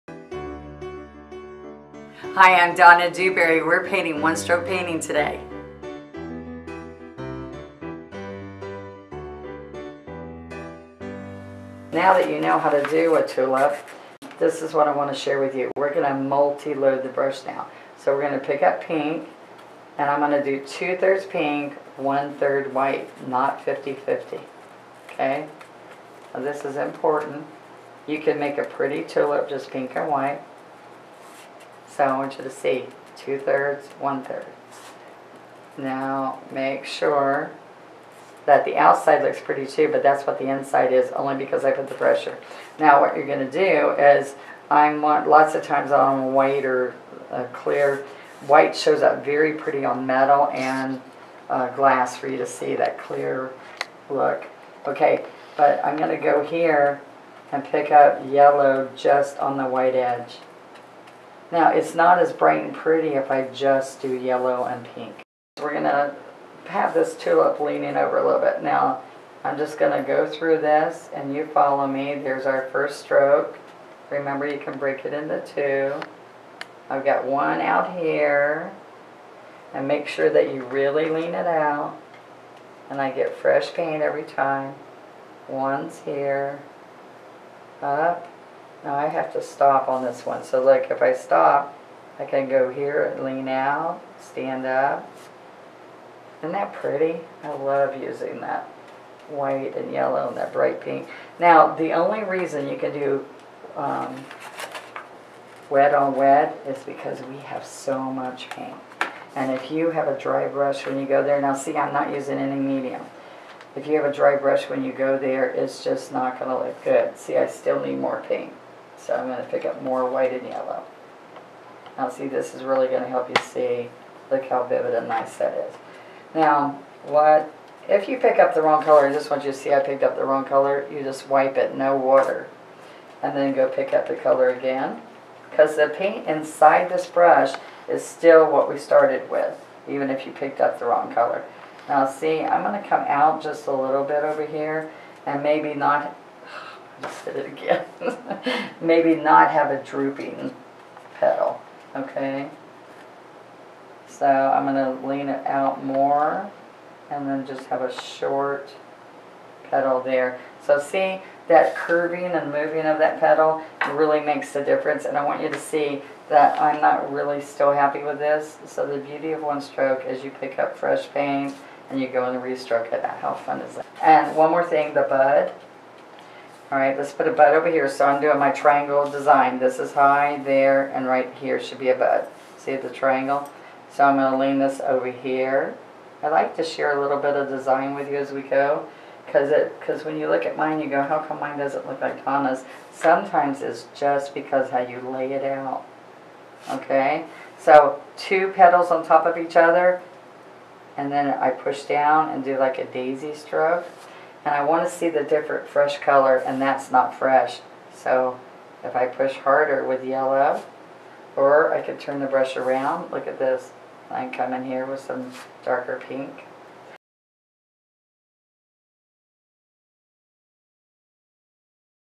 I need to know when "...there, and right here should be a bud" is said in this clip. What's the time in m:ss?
3:00.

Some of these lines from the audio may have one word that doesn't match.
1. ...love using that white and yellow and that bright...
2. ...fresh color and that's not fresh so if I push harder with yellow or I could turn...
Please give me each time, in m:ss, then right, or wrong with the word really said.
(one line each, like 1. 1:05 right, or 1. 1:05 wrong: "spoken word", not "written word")
1. 1:37 right
2. 3:25 right.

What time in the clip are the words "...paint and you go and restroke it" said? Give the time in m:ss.
2:51.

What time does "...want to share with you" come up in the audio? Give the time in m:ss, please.
0:14.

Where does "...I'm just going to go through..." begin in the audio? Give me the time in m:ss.
1:09.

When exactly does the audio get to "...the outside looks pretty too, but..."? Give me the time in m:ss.
0:38.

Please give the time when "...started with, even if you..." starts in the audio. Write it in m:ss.
2:18.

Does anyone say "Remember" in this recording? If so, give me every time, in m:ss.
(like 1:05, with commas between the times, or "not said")
1:14.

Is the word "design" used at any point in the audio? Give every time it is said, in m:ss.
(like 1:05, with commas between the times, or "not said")
2:59, 3:07.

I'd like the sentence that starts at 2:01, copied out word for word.
Now see, this is really going to help you see, look how vivid and nice that is.